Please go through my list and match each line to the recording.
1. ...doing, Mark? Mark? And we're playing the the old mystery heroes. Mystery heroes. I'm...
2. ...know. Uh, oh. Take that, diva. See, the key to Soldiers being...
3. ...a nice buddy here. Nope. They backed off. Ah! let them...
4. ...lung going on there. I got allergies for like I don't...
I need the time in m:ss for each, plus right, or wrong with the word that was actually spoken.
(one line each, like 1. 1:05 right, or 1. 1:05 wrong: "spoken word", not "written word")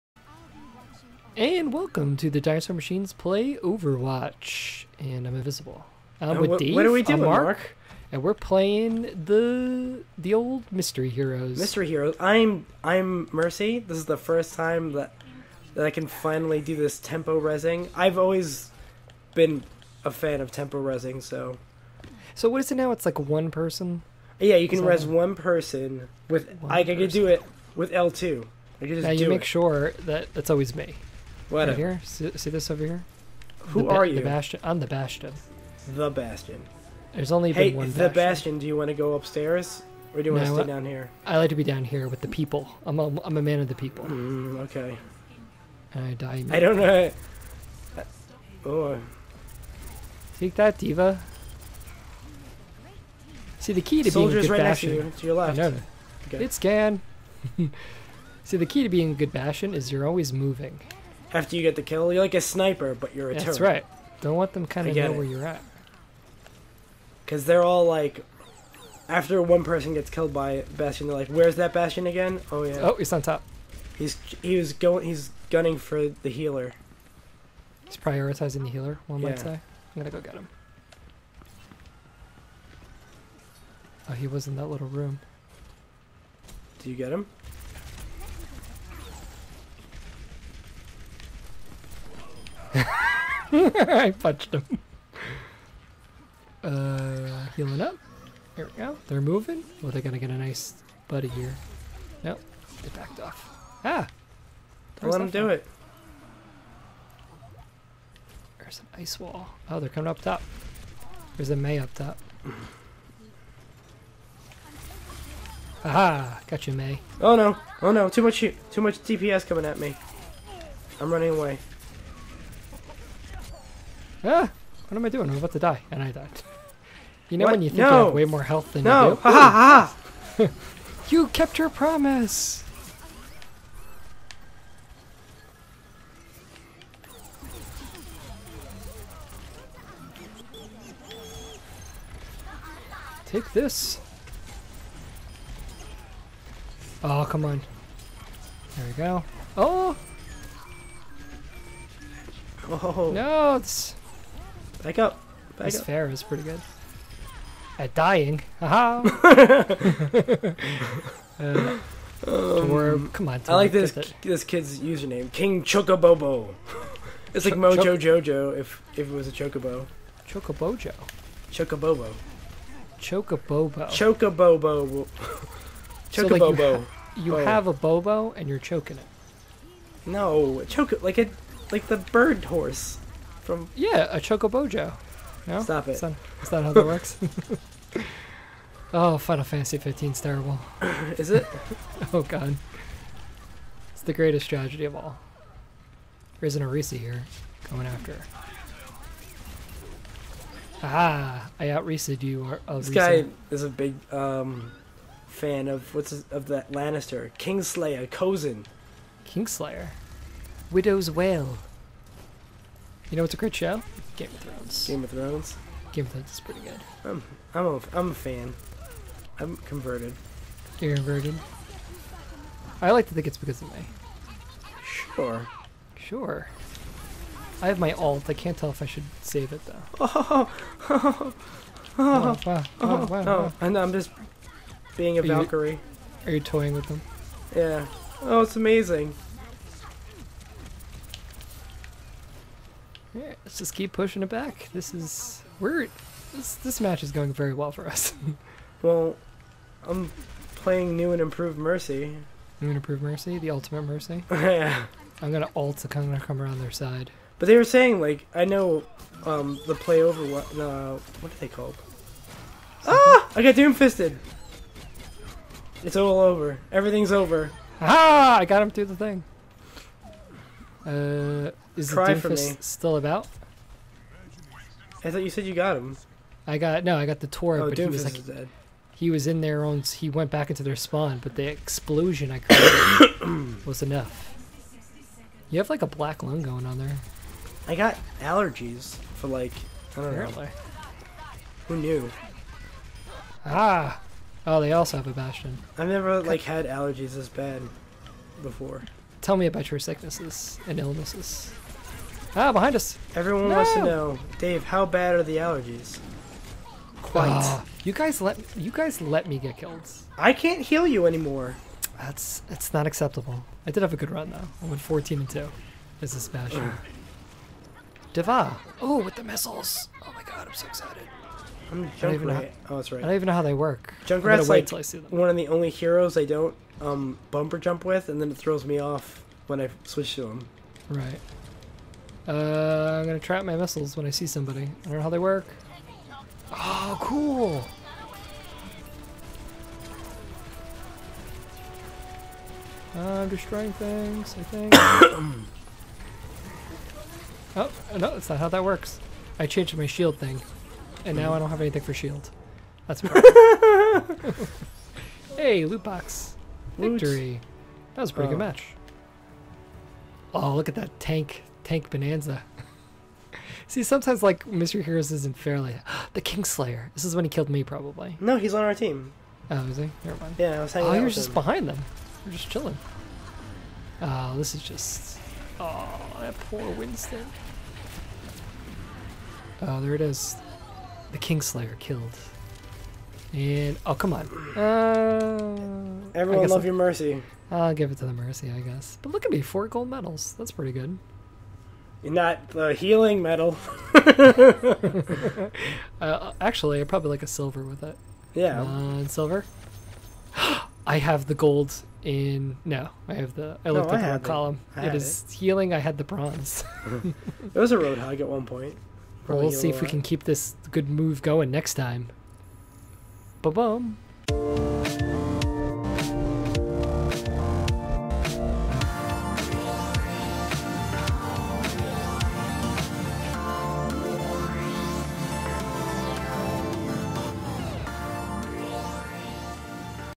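1. 0:07 right
2. 0:46 right
3. 1:40 right
4. 4:46 right.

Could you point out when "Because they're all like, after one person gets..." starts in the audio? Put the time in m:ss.
1:07.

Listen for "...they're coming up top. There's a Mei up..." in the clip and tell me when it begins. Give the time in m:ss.
1:49.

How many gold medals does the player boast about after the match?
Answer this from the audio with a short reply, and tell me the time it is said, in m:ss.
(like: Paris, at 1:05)
4, at 6:29.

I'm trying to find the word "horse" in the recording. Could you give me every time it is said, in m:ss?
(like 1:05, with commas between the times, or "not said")
3:02.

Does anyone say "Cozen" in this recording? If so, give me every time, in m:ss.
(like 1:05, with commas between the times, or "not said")
3:28.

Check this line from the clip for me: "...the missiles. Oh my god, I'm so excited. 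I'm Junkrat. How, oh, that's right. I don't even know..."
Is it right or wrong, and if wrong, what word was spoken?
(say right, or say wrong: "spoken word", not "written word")
right.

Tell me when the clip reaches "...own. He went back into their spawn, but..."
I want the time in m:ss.
4:39.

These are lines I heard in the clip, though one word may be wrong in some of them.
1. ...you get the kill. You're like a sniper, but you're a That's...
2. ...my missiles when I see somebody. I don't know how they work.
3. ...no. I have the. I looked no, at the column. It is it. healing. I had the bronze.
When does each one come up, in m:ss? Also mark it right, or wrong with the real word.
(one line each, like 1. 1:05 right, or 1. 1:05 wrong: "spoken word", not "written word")
1. 1:01 right
2. 5:33 right
3. 6:42 right.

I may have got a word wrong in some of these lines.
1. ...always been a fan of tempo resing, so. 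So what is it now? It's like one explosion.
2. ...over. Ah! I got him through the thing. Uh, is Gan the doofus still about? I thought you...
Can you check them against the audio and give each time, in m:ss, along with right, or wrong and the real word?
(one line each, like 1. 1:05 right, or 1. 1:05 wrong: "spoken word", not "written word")
1. 0:18 wrong: "person", not "explosion"
2. 4:27 wrong: "Cry", not "Gan".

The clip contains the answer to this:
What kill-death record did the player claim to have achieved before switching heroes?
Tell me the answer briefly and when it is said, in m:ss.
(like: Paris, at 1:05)
14 and 2, at 5:14.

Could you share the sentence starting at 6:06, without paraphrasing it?
This is when he killed me, probably.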